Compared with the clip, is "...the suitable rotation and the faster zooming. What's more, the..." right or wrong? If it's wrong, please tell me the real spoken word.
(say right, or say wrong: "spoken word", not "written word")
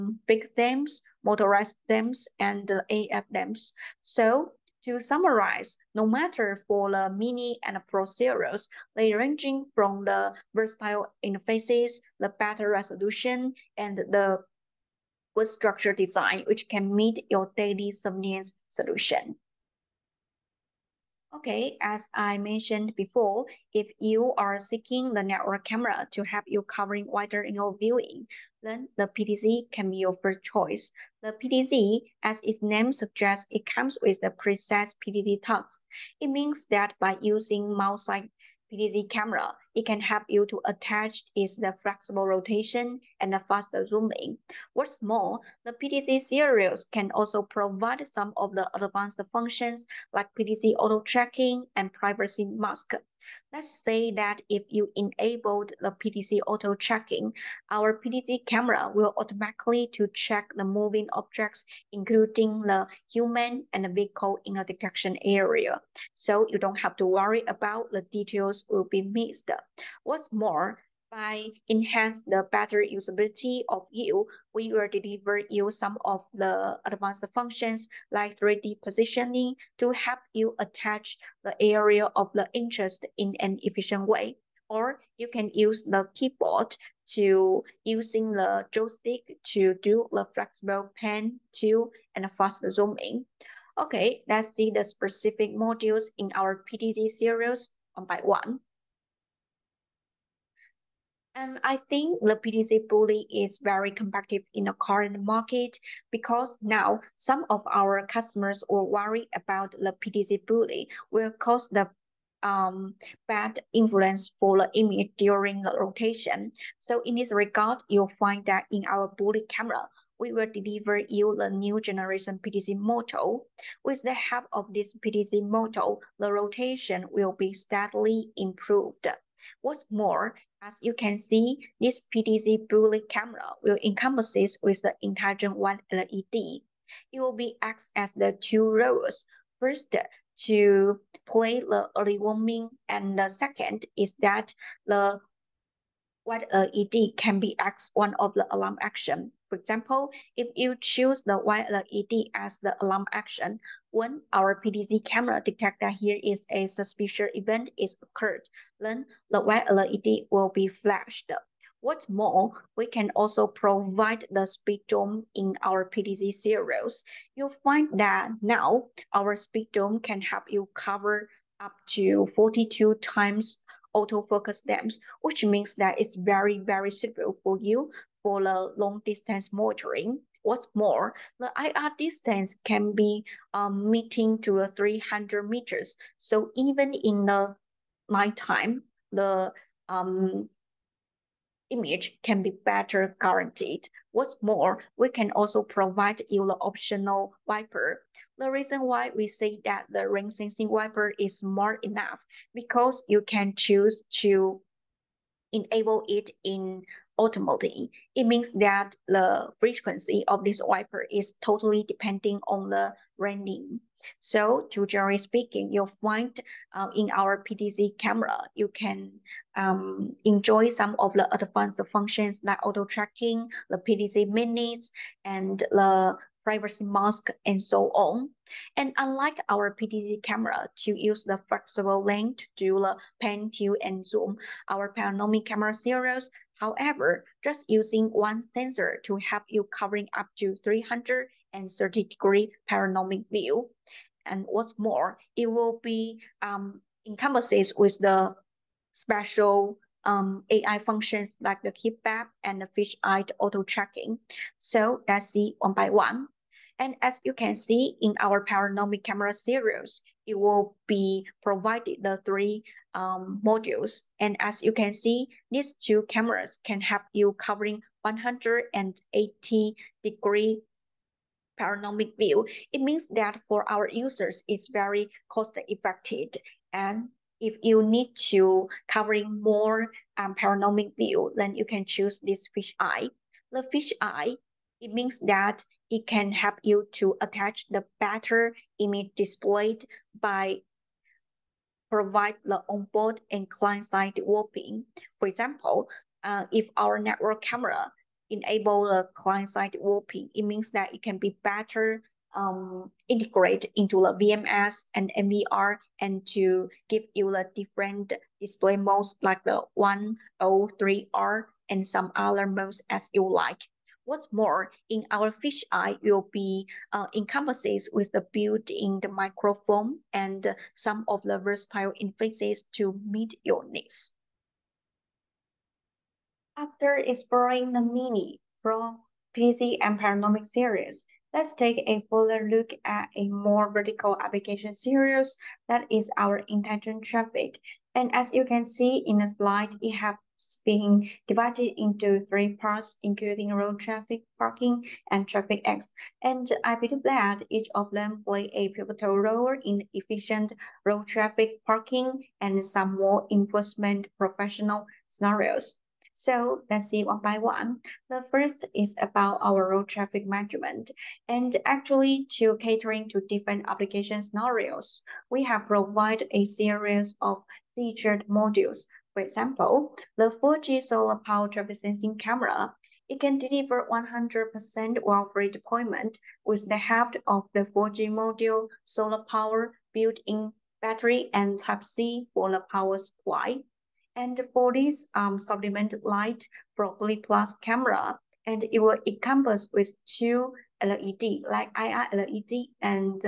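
wrong: "flexible", not "suitable".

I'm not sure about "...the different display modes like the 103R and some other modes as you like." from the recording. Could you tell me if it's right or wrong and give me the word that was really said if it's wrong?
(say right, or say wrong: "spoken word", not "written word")
right.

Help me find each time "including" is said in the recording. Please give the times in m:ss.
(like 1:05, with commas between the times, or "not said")
1:01, 5:43.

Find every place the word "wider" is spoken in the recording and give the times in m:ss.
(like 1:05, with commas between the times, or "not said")
0:27.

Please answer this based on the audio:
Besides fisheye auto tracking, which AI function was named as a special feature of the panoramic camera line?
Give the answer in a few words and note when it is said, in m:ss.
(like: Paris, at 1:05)
heat map, at 4:11.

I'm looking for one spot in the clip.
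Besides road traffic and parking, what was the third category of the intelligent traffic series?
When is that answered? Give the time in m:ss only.
5:45.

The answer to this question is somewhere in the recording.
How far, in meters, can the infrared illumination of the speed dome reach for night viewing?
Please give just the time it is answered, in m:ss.
3:04.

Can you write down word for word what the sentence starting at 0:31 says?
The PTZ, as its name suggests, it comes with the precise PTZ tags.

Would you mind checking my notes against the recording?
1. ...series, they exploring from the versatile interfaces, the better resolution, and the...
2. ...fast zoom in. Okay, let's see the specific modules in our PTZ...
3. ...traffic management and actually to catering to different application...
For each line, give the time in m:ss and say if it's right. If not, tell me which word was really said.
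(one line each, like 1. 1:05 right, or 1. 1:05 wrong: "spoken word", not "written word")
1. 0:08 wrong: "ranging", not "exploring"
2. 1:32 right
3. 5:59 right.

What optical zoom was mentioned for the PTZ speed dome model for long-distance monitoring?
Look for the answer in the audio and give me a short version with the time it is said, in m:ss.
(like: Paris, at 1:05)
42 times, at 2:52.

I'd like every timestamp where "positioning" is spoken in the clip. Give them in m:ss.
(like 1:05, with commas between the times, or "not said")
1:18.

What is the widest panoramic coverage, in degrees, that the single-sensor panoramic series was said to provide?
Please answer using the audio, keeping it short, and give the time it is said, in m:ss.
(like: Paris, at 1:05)
330 degrees, at 4:00.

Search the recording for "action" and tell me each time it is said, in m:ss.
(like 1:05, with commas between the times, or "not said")
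2:28, 2:33.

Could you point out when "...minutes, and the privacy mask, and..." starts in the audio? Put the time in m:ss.
3:44.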